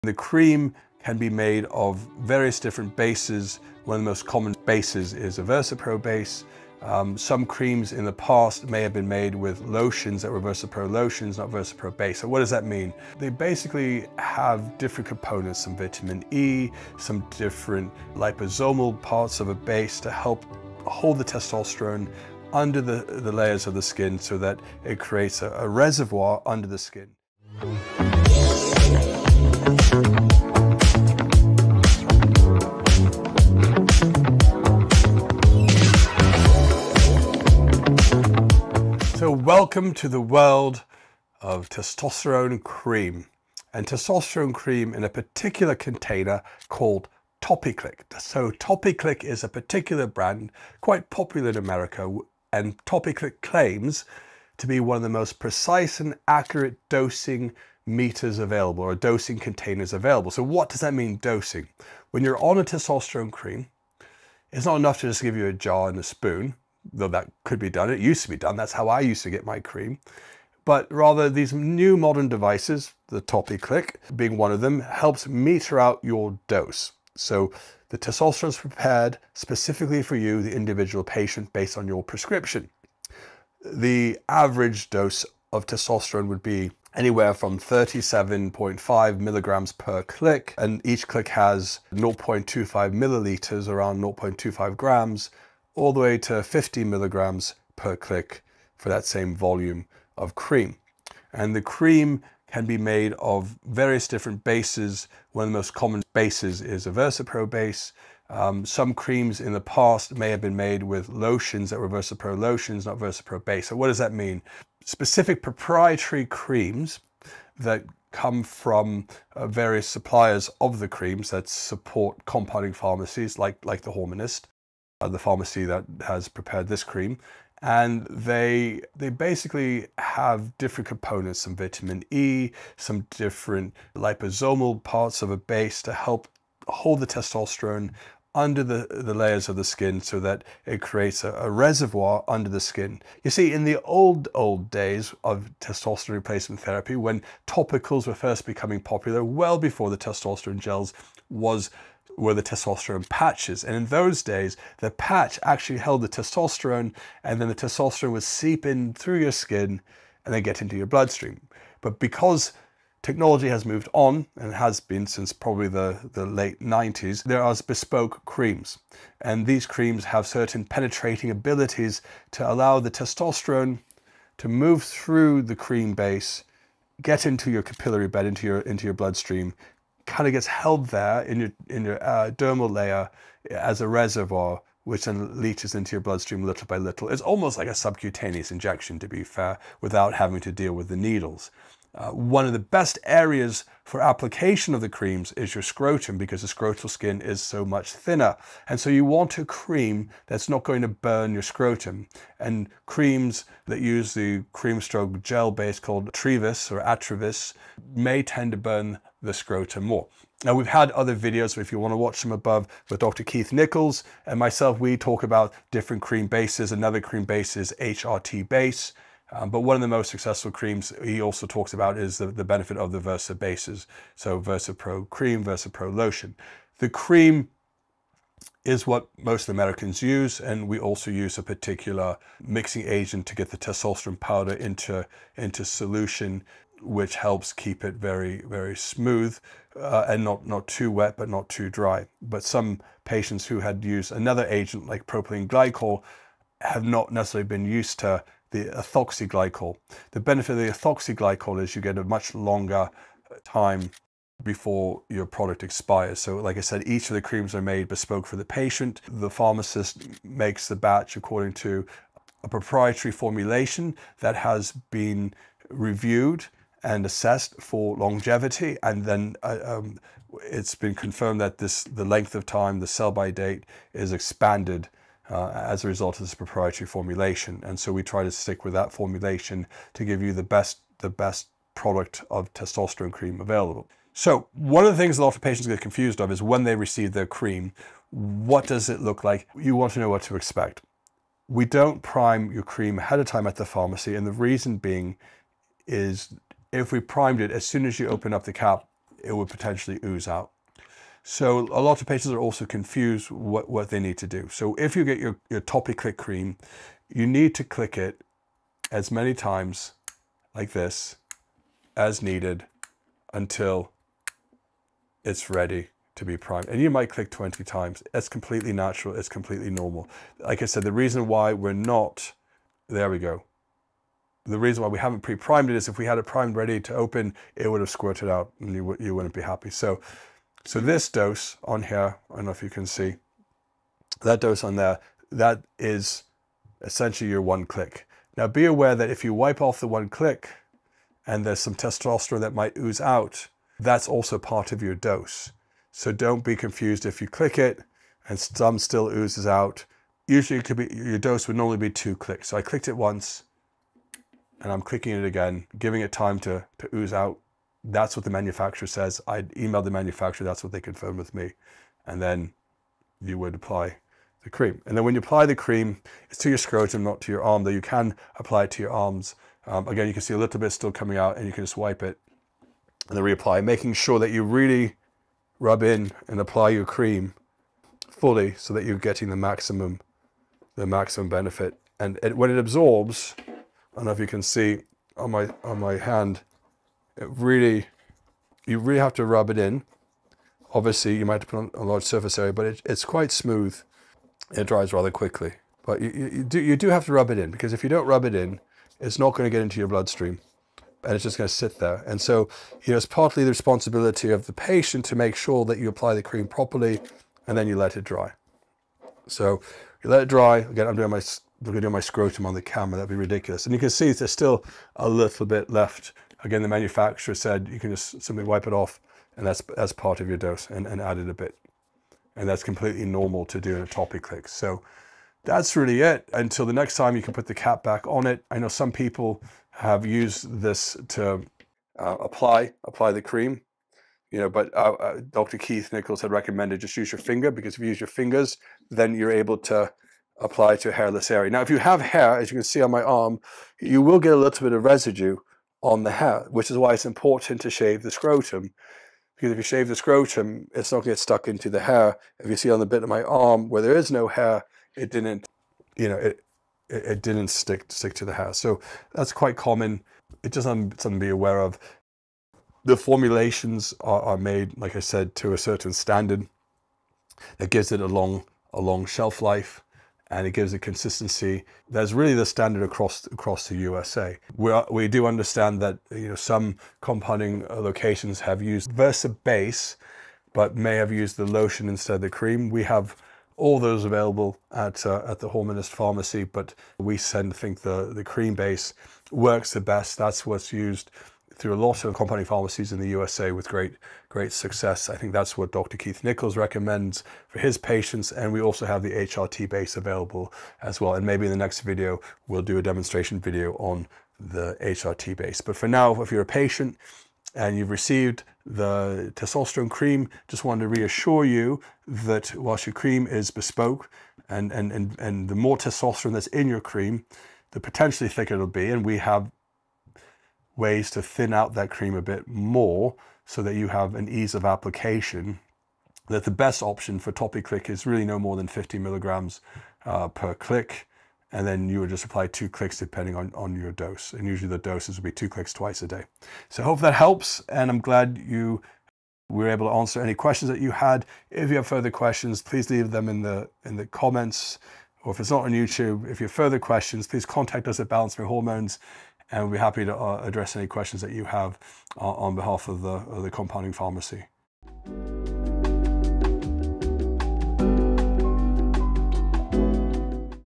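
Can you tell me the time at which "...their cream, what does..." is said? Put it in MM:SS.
04:47.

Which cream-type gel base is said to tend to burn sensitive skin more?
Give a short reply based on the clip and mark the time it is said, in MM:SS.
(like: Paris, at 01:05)
Atrevis, at 03:26.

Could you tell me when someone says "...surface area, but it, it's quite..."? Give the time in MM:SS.
06:32.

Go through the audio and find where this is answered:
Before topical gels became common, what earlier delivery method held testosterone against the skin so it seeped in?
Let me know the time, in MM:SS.
02:32.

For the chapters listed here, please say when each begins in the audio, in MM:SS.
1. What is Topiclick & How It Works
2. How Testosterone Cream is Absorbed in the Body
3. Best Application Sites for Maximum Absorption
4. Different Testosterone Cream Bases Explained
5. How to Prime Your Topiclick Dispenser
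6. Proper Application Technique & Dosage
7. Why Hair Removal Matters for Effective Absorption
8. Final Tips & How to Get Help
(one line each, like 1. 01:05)
1. 00:41
2. 01:41
3. 02:56
4. 04:14
5. 05:24
6. 06:30
7. 07:28
8. 08:39.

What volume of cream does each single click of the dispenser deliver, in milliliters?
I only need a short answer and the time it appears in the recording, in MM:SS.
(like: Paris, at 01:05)
0.25 milliliters, at 01:31.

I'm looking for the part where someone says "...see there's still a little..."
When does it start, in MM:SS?
06:53.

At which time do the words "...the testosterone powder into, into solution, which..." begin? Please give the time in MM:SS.
03:53.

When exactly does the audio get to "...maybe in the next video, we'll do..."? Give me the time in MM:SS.
08:21.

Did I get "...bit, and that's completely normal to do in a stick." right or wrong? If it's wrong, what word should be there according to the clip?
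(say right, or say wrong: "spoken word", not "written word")
wrong: "click", not "stick".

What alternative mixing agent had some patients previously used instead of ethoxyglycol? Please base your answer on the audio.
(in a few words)
propylene glycol.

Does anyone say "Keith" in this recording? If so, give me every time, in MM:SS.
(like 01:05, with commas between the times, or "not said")
03:33, 07:15, 08:15.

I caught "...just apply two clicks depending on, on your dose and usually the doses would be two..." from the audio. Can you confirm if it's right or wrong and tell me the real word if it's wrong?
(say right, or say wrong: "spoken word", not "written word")
right.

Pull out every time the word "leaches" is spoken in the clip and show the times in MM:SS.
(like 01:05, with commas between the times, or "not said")
03:05.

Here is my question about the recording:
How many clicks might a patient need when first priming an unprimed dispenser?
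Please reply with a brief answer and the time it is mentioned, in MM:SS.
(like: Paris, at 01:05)
20, at 05:17.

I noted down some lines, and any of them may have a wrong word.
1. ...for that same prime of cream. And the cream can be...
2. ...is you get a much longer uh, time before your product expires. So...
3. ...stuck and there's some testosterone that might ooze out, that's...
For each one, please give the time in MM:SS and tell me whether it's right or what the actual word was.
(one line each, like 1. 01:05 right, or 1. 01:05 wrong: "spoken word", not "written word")
1. 01:38 wrong: "volume", not "prime"
2. 04:11 right
3. 05:40 wrong: "click", not "stuck".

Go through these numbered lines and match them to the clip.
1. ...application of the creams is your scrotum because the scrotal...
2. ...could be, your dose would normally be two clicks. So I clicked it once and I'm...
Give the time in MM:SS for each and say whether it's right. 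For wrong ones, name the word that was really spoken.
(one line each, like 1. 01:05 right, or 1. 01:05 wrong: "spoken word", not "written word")
1. 03:14 right
2. 05:50 right.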